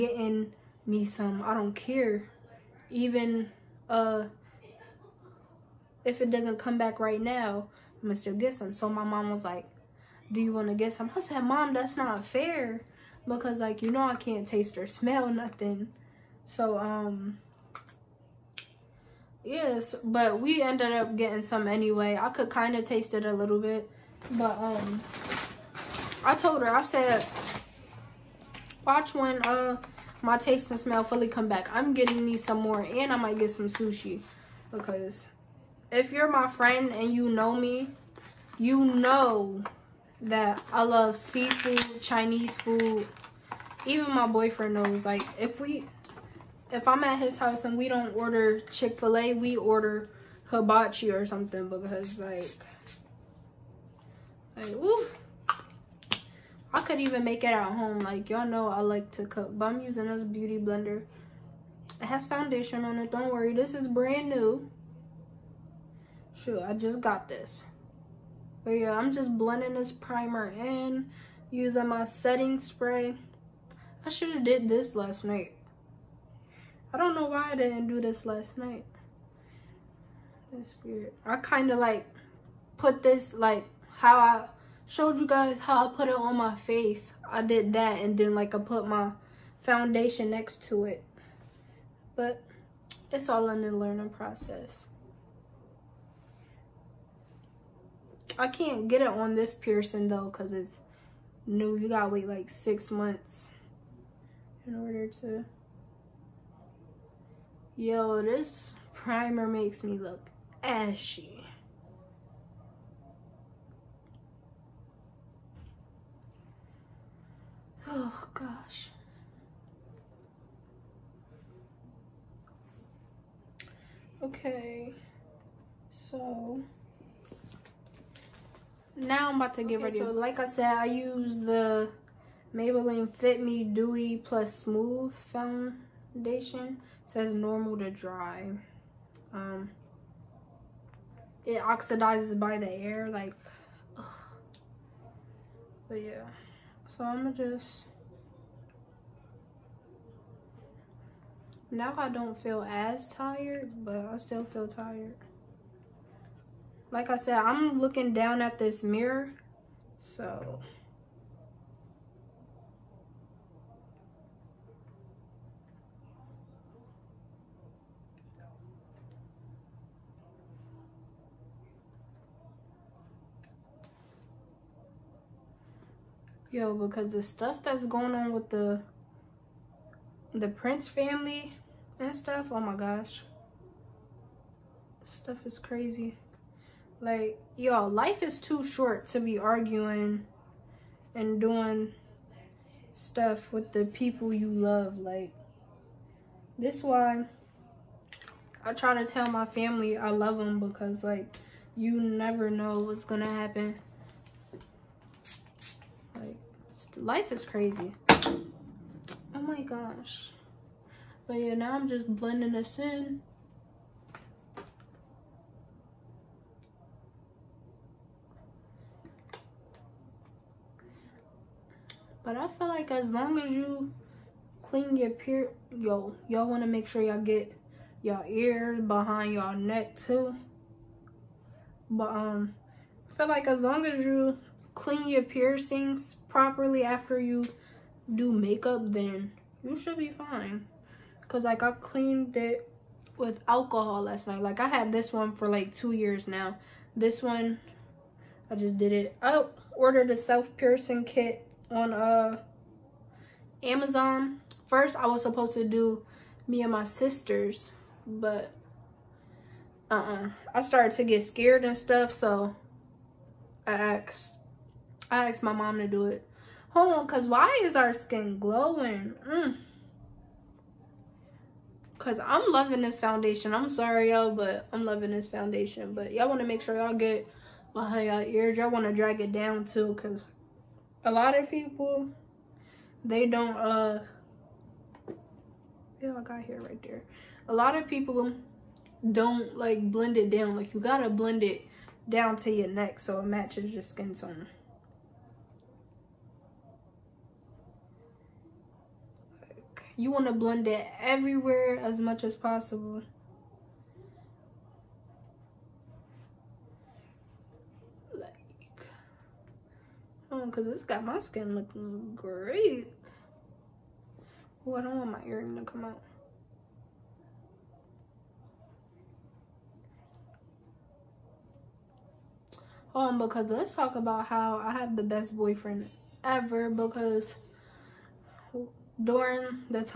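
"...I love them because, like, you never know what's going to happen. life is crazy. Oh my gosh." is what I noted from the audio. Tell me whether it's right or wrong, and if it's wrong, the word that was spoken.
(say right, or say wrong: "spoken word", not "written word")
right.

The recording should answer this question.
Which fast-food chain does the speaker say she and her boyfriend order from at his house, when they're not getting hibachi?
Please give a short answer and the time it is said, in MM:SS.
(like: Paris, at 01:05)
Chick-fil-A, at 00:48.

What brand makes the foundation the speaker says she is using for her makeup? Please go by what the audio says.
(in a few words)
Maybelline.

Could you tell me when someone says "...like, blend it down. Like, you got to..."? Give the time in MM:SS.
04:49.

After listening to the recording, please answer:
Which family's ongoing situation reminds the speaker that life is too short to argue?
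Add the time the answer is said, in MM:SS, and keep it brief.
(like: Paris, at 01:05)
Prince, at 03:00.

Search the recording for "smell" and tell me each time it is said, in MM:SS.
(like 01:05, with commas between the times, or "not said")
00:14, 00:30.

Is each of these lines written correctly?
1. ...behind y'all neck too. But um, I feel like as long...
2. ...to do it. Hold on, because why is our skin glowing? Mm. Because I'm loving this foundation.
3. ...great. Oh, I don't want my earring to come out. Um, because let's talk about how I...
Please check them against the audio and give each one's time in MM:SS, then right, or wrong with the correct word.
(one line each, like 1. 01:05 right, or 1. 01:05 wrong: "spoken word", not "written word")
1. 03:48 right
2. 04:25 right
3. 05:12 right.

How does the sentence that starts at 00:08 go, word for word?
So my mom was like, do you want to get some?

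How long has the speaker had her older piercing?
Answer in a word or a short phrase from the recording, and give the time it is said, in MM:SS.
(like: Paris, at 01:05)
2 years, at 04:05.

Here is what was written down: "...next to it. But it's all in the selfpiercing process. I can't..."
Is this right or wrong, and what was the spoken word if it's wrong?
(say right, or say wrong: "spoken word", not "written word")
wrong: "learning", not "selfpiercing".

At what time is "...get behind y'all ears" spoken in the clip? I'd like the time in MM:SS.
04:36.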